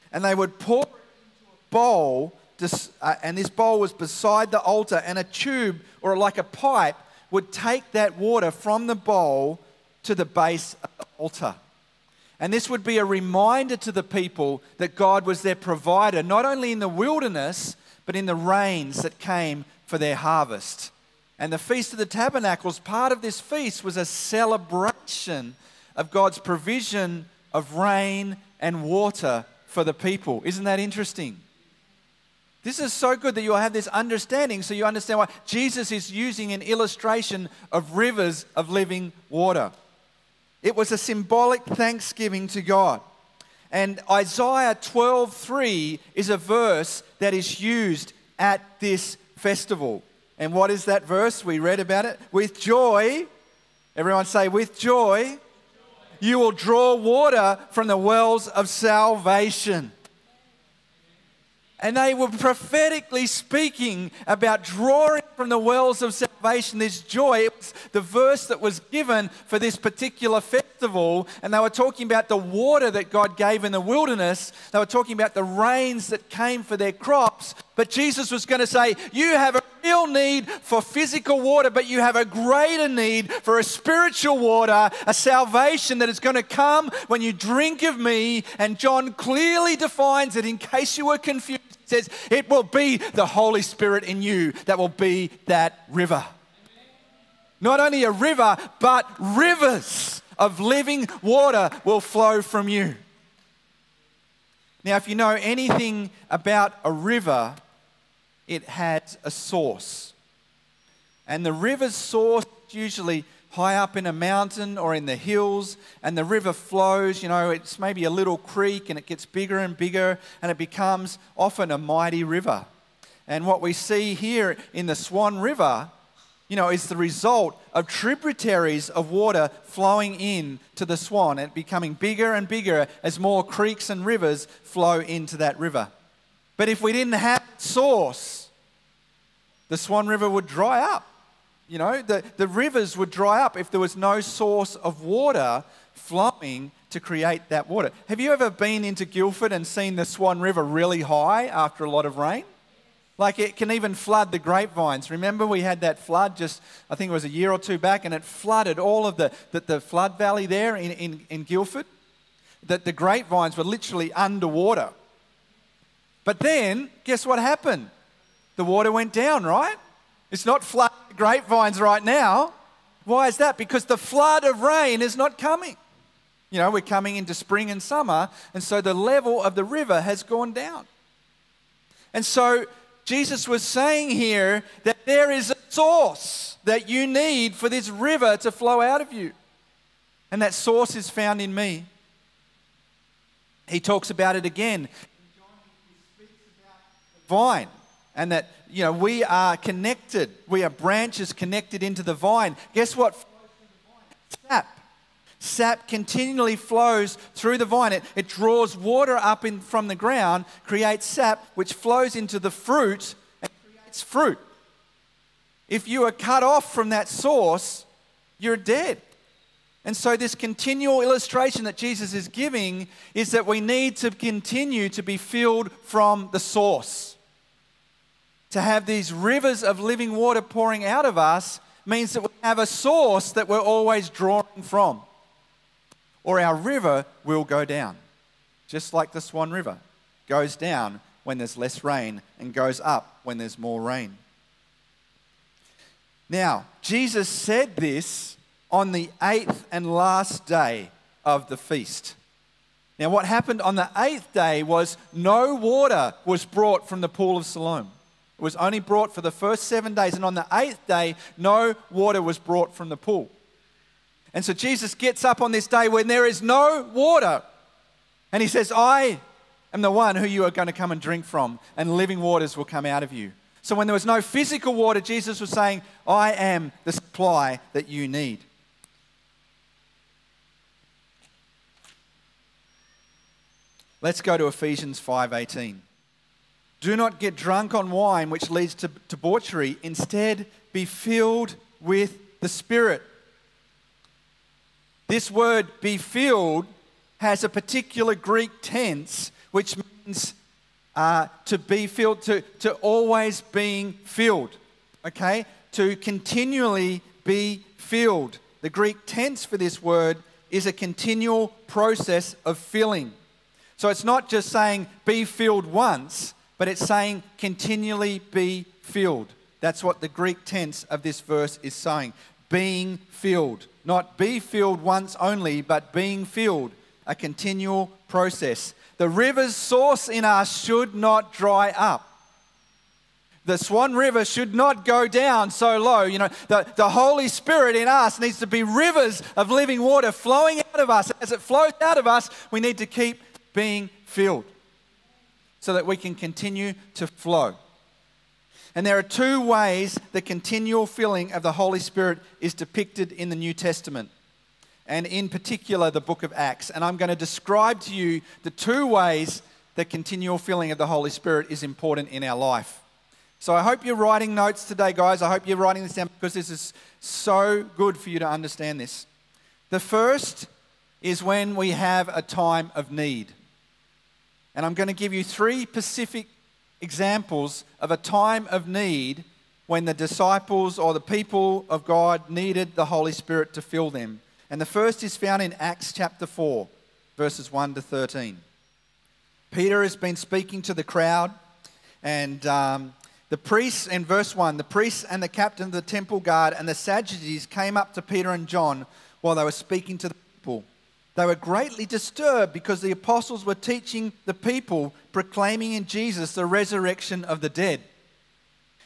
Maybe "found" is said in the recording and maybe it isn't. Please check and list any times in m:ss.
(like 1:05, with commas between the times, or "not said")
3:11, 6:25.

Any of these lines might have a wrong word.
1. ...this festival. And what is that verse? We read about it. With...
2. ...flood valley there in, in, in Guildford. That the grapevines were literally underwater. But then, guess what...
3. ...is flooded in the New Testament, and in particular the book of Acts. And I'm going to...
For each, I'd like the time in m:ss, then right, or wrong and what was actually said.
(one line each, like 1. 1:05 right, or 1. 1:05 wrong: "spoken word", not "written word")
1. 0:48 right
2. 2:39 right
3. 5:52 wrong: "depicted", not "flooded".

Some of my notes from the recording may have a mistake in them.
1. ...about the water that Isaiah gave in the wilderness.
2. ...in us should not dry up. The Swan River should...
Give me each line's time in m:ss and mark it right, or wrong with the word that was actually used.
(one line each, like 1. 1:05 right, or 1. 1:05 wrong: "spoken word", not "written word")
1. 1:12 wrong: "God", not "Isaiah"
2. 5:30 right.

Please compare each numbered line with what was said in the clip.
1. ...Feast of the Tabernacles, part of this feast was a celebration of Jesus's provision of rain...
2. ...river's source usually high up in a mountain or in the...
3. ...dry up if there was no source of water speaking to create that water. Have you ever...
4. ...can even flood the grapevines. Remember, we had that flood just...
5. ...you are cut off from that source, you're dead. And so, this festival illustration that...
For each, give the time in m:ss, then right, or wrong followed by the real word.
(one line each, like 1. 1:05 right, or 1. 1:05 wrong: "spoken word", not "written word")
1. 0:21 wrong: "God", not "Jesus"
2. 1:51 right
3. 2:23 wrong: "flowing", not "speaking"
4. 2:33 right
5. 3:35 wrong: "continual", not "festival".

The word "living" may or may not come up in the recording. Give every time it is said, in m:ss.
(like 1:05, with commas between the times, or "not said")
0:38, 1:40, 3:49, 4:31, 5:39.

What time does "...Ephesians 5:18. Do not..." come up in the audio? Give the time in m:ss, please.
4:44.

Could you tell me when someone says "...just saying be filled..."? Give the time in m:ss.
5:14.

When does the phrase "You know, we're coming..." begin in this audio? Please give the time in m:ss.
2:56.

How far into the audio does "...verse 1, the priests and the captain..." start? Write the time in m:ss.
6:34.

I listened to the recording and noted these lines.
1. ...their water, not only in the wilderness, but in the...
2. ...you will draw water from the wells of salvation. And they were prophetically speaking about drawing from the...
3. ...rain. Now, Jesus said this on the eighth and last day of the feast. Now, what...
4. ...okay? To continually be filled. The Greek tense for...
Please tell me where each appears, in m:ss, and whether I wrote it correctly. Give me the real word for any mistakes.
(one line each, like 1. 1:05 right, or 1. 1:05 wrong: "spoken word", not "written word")
1. 0:15 wrong: "provider", not "water"
2. 0:56 right
3. 4:03 right
4. 5:05 right.